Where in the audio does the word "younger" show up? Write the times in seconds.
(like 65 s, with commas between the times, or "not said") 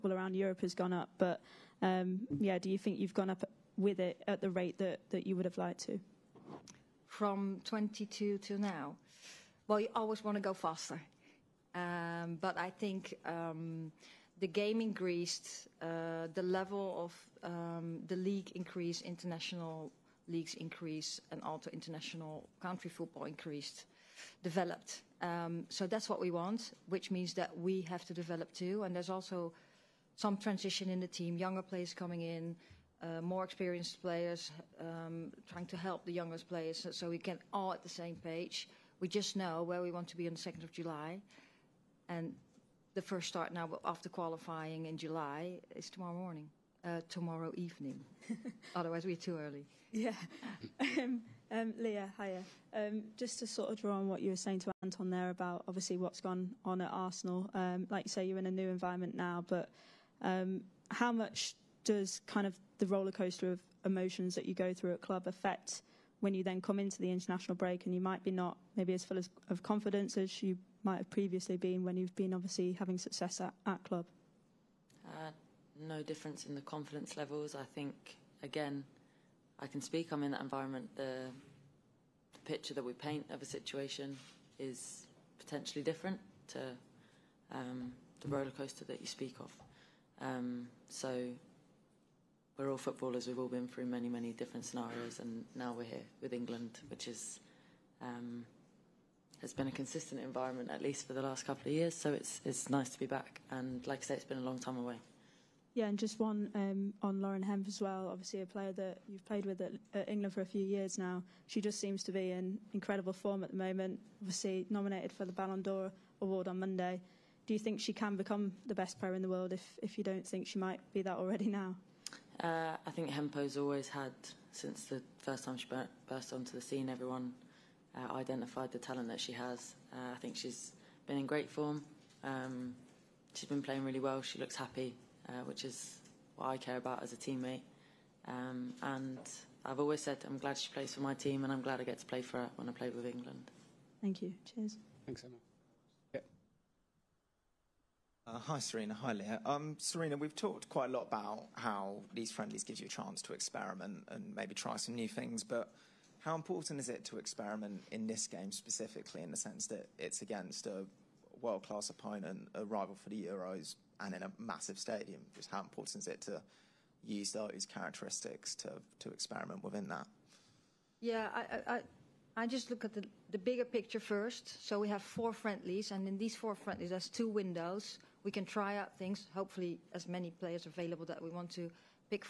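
31 s, 36 s.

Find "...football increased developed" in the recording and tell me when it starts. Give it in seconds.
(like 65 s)
22 s.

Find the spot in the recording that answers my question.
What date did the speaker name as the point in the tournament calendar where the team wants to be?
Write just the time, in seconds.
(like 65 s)
40 s.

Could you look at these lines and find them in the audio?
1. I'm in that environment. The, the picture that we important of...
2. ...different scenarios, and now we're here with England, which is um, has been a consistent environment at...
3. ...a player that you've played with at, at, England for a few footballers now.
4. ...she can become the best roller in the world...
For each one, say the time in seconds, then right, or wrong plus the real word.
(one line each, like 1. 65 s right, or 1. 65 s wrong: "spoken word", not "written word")
1. 80 s wrong: "paint", not "important"
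2. 94 s right
3. 108 s wrong: "years", not "footballers"
4. 117 s wrong: "player", not "roller".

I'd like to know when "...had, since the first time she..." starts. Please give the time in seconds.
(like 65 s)
123 s.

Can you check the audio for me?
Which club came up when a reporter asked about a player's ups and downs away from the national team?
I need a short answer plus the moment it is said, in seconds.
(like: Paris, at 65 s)
Arsenal, at 56 s.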